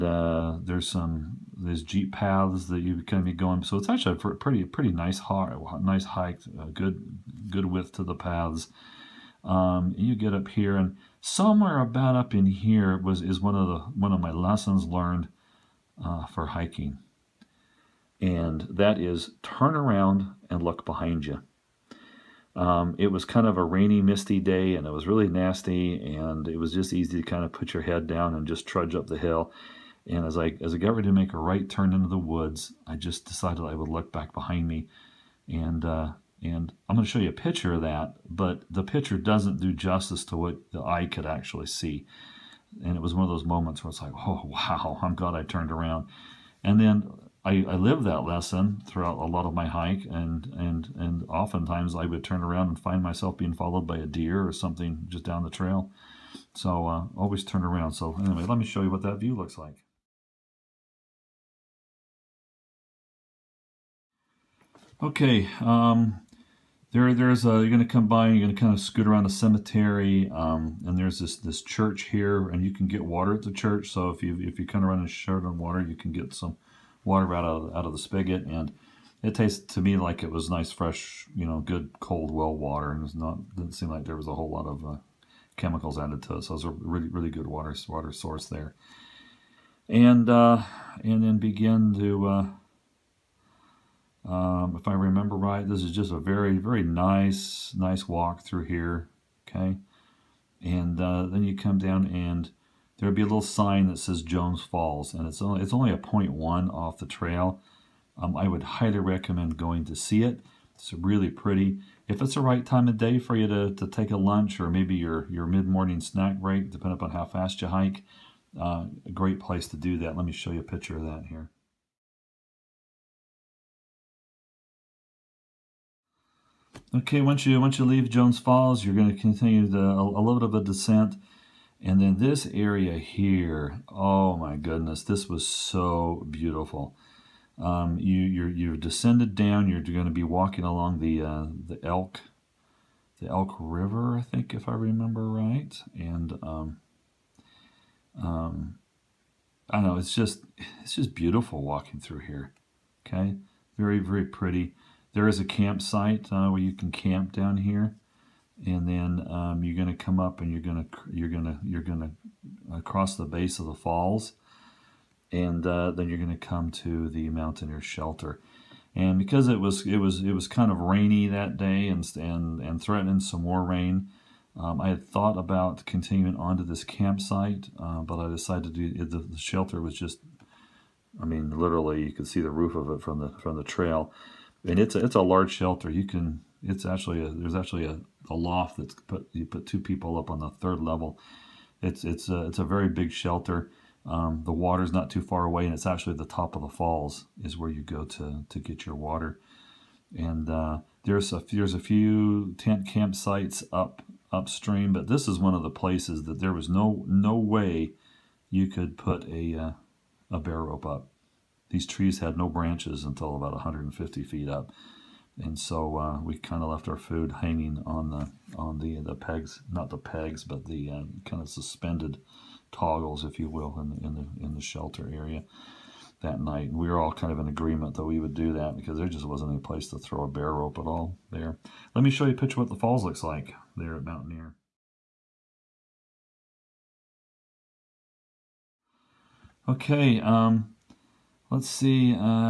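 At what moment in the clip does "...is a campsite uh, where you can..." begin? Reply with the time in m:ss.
2:35.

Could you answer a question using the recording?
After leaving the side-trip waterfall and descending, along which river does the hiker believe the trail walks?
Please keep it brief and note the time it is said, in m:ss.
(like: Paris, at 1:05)
Elk River, at 2:23.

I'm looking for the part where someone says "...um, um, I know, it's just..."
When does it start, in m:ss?
2:26.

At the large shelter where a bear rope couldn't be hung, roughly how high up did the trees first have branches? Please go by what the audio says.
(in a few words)
150 feet.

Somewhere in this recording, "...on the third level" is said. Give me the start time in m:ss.
3:10.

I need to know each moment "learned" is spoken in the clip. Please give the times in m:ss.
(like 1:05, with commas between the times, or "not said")
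0:14.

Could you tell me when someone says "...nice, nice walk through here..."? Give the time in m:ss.
1:36.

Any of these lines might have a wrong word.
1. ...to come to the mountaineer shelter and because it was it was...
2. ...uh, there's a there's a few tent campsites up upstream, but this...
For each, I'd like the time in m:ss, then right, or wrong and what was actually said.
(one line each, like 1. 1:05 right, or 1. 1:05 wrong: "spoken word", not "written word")
1. 2:46 right
2. 3:20 right.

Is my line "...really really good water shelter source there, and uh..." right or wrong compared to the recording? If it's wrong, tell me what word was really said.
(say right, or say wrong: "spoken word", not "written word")
wrong: "water", not "shelter".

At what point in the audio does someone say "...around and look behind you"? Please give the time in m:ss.
0:19.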